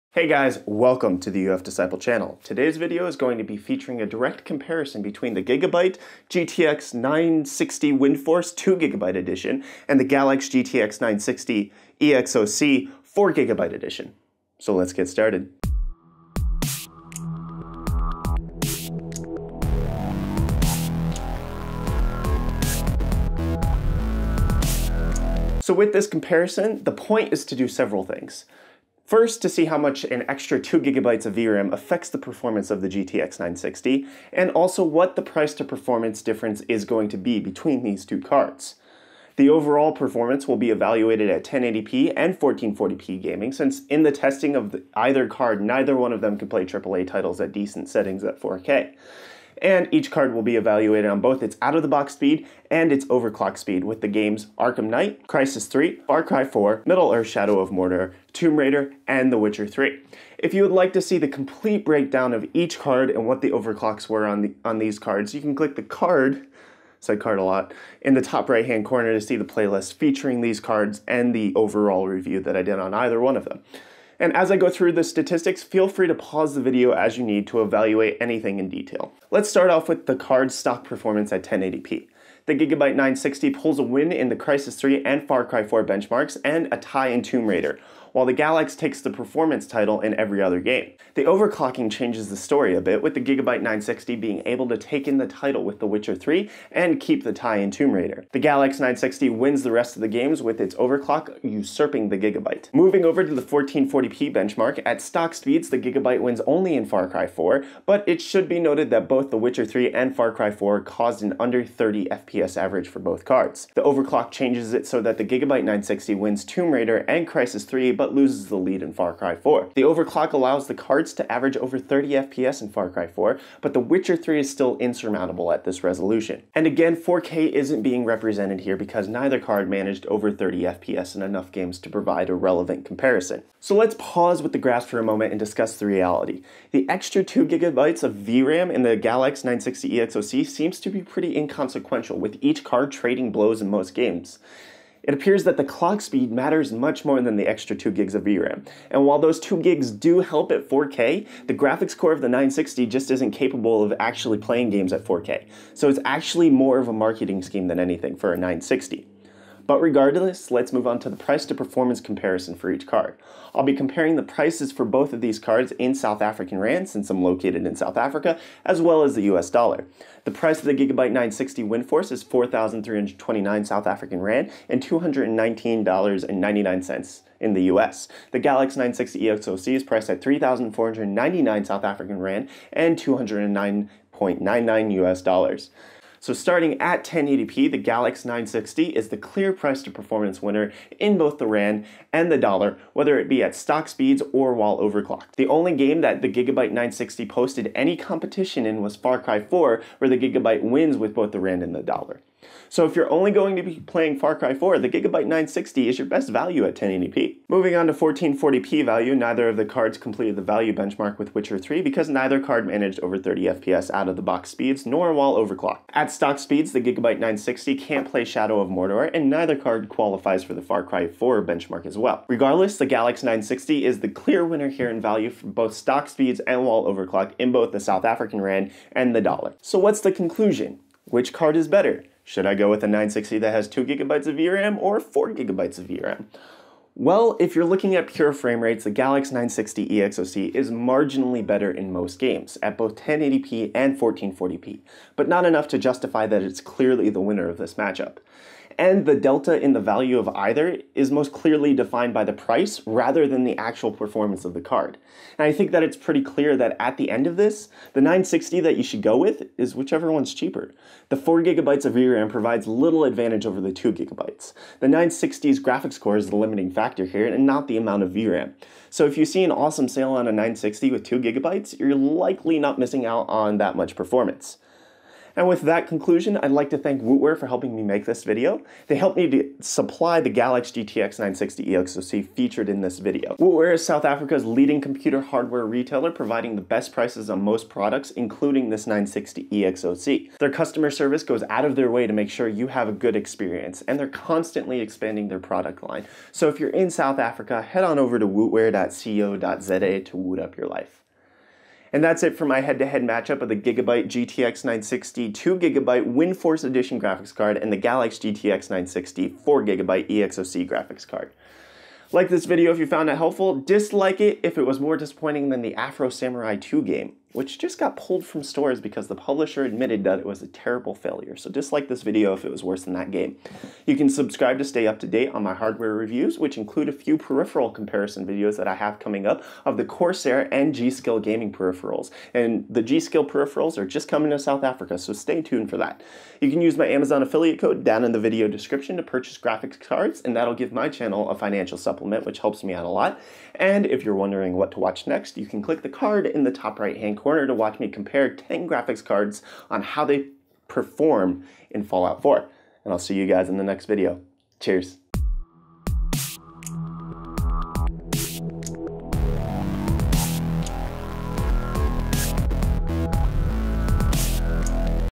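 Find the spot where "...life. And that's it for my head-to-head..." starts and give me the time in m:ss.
5:00.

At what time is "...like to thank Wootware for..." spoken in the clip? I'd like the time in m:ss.
4:36.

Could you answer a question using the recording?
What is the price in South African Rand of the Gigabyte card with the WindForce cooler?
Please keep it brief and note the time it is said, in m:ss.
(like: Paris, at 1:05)
4,329 Rand, at 2:52.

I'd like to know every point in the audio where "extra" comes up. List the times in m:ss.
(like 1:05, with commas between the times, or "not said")
0:30, 2:16, 2:27.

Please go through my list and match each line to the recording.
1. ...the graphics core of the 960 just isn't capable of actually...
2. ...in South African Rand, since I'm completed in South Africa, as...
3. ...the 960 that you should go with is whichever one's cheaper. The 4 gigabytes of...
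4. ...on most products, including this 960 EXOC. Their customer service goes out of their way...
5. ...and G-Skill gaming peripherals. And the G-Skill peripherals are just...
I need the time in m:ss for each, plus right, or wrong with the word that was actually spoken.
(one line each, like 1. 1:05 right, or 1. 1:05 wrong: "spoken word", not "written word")
1. 2:31 right
2. 2:45 wrong: "located", not "completed"
3. 4:17 right
4. 4:47 right
5. 5:30 right.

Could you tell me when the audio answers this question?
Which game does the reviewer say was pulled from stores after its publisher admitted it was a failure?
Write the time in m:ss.
5:15.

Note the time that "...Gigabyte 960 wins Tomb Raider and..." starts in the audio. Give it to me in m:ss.
1:55.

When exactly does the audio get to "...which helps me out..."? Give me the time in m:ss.
5:42.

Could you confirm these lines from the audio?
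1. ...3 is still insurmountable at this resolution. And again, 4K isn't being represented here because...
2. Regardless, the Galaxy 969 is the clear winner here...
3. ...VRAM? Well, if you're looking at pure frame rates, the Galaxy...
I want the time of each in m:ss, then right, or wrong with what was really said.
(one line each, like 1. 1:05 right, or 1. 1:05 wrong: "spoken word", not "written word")
1. 2:04 right
2. 3:42 wrong: "960", not "969"
3. 3:55 right.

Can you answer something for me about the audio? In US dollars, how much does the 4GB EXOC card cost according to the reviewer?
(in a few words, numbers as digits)
$209.99.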